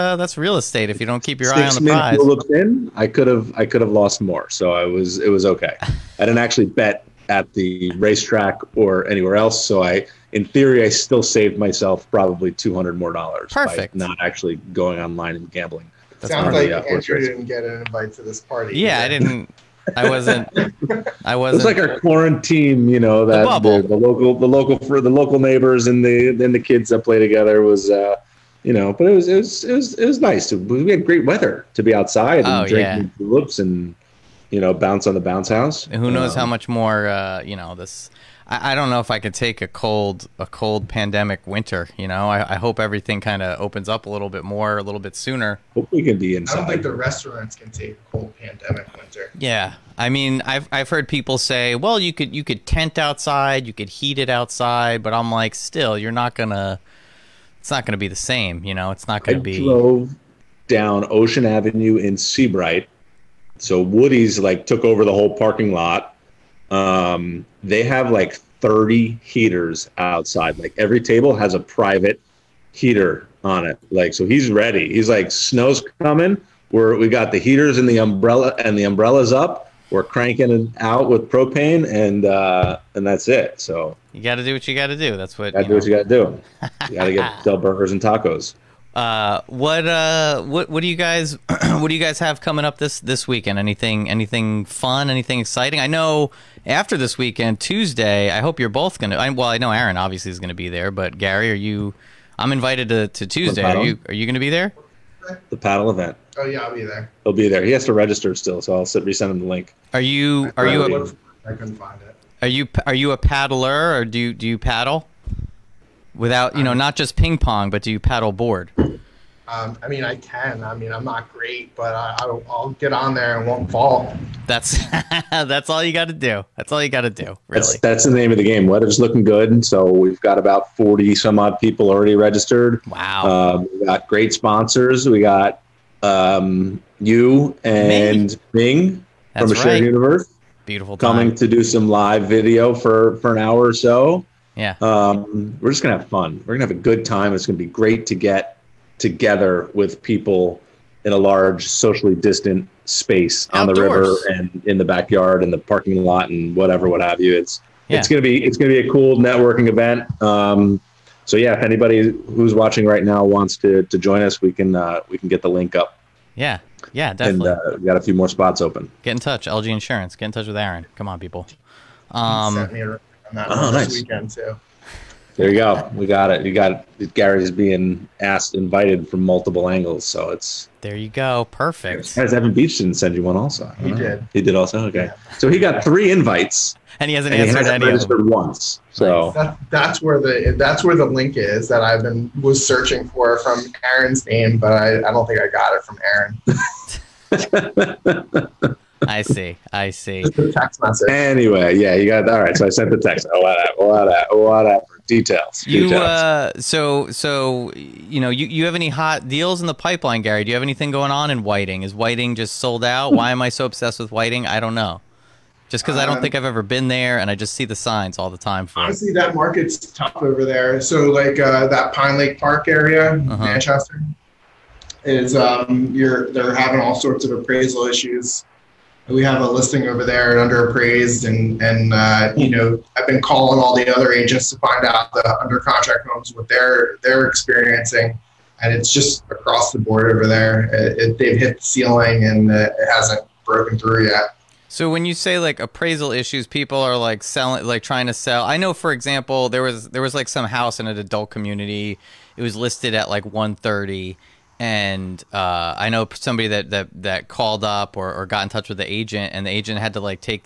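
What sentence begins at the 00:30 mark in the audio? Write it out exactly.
We had great weather to be outside and oh, yeah.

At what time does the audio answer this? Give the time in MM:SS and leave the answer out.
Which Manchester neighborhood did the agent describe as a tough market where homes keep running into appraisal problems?
03:41.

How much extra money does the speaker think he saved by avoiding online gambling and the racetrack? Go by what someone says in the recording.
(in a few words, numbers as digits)
$200.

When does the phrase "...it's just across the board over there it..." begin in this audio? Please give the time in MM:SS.
03:58.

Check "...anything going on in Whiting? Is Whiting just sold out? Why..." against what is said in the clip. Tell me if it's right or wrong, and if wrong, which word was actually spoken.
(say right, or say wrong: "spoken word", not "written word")
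right.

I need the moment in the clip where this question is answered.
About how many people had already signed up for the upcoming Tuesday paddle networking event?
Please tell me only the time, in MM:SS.
02:10.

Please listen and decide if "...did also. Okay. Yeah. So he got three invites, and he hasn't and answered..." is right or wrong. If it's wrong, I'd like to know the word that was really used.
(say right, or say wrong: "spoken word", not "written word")
right.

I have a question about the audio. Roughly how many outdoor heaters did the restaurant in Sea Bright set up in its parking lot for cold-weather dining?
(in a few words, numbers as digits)
30.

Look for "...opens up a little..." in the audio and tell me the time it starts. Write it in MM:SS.
00:43.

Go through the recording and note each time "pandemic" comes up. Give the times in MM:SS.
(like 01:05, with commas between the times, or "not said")
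00:40, 00:48.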